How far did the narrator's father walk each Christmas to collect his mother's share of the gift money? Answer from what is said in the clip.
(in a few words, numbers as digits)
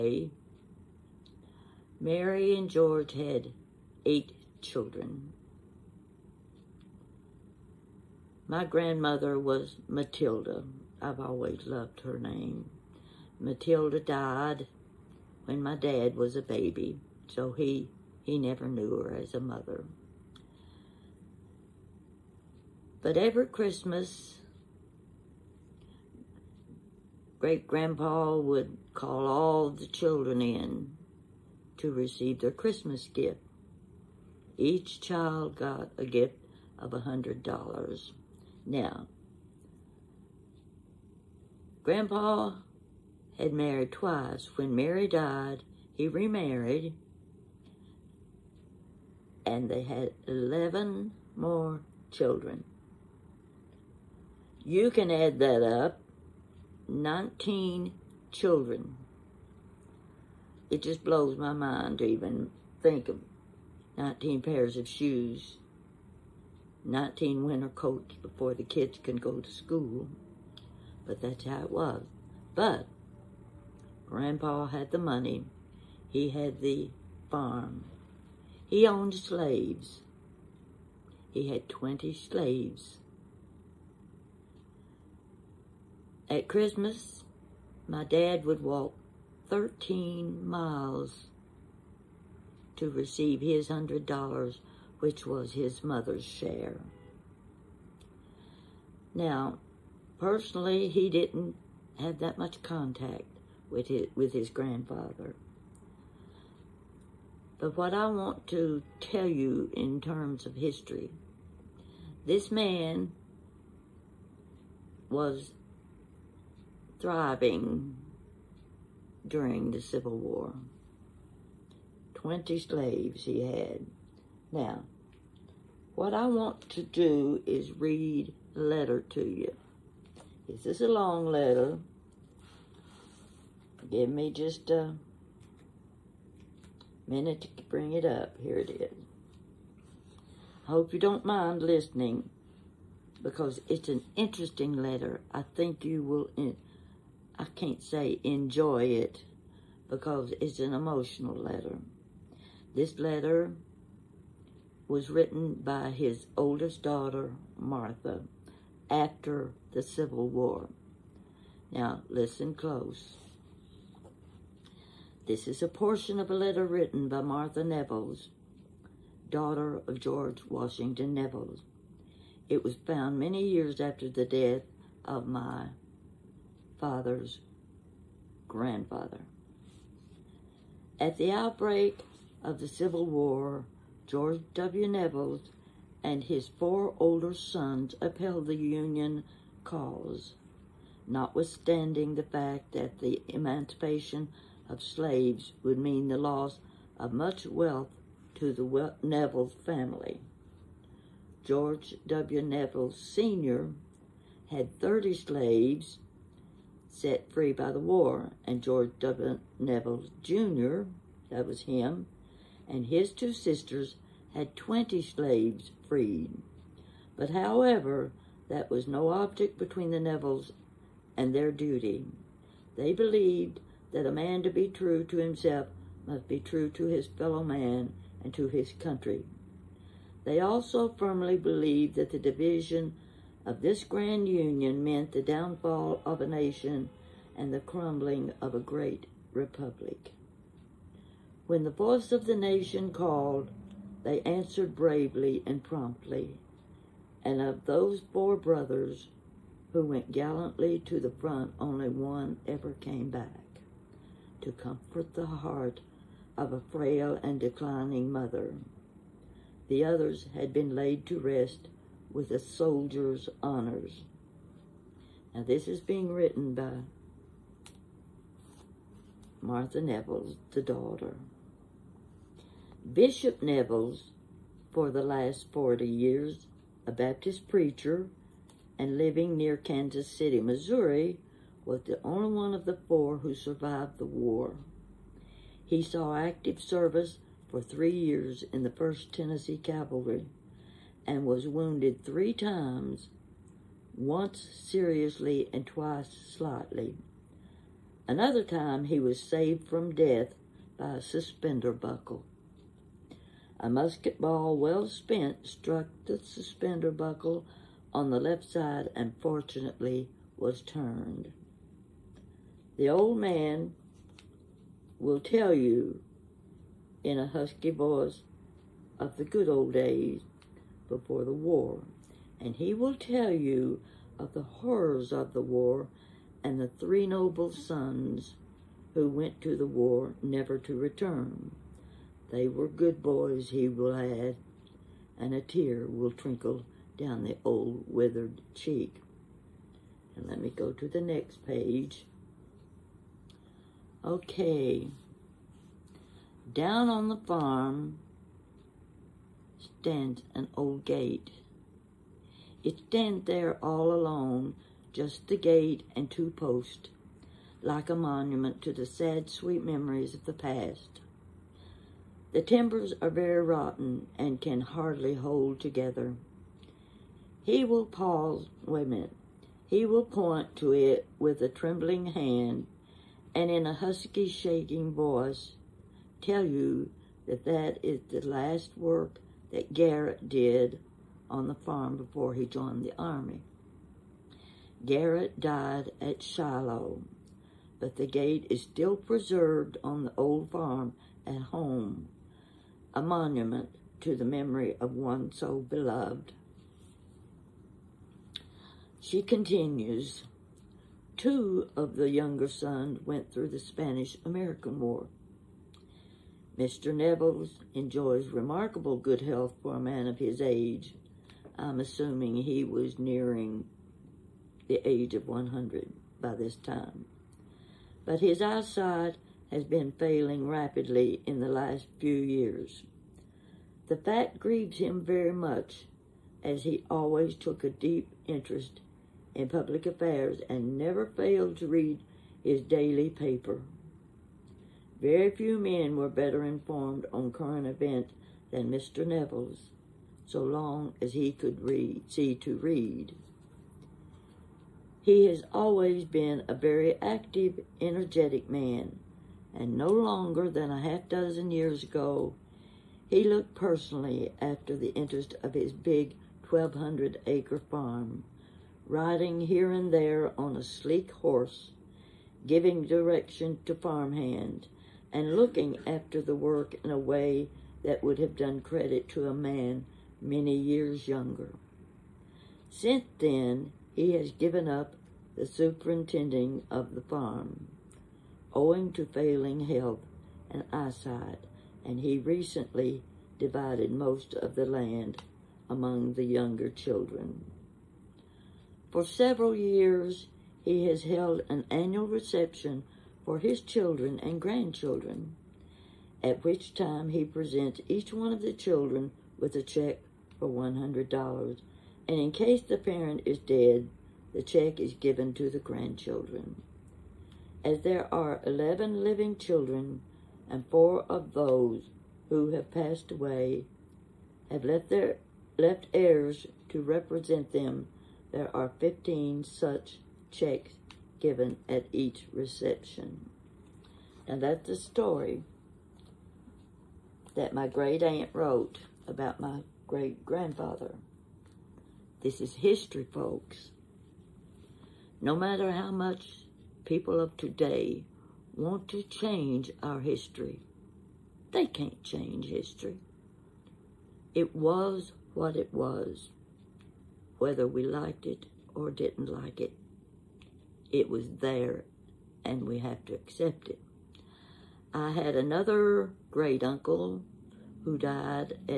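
13 miles.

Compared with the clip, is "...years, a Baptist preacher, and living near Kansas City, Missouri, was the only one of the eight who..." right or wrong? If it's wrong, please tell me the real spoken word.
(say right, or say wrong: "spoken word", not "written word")
wrong: "four", not "eight".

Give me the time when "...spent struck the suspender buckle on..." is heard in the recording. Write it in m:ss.
5:04.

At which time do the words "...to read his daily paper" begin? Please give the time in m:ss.
7:11.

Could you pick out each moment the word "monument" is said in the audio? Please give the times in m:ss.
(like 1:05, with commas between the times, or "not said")
5:57, 6:33.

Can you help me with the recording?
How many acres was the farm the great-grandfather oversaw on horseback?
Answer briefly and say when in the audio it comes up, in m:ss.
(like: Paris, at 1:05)
1,200 acres, at 7:36.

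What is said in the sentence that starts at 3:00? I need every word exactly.
At the outbreak of the Civil War, George W.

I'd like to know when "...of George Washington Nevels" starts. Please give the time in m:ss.
2:49.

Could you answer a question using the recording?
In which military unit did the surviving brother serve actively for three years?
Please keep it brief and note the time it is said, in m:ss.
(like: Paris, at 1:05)
1st Tennessee Cavalry, at 4:48.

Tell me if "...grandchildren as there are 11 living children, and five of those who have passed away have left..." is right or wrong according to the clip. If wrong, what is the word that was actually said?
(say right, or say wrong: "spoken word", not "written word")
wrong: "four", not "five".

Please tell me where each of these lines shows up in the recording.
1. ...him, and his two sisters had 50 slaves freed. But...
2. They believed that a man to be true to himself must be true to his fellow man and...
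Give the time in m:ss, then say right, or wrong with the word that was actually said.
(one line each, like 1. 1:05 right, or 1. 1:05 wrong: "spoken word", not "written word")
1. 3:31 wrong: "20", not "50"
2. 3:42 right.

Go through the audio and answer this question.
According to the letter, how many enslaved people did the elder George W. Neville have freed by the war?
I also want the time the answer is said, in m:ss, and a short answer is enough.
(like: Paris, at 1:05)
30, at 3:24.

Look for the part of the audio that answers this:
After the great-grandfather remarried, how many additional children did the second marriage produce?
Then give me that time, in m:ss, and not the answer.
0:50.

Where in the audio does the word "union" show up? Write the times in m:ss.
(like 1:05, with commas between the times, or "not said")
3:08, 3:54.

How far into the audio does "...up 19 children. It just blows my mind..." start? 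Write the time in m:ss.
0:55.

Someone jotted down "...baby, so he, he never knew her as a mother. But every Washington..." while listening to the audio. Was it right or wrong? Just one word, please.
wrong.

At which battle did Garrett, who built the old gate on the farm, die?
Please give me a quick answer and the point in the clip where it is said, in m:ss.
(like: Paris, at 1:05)
Shiloh, at 6:26.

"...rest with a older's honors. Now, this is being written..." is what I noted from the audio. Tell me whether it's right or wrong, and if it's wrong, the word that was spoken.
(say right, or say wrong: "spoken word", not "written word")
wrong: "soldier", not "older".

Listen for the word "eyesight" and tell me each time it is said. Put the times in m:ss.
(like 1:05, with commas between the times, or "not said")
6:58, 8:00.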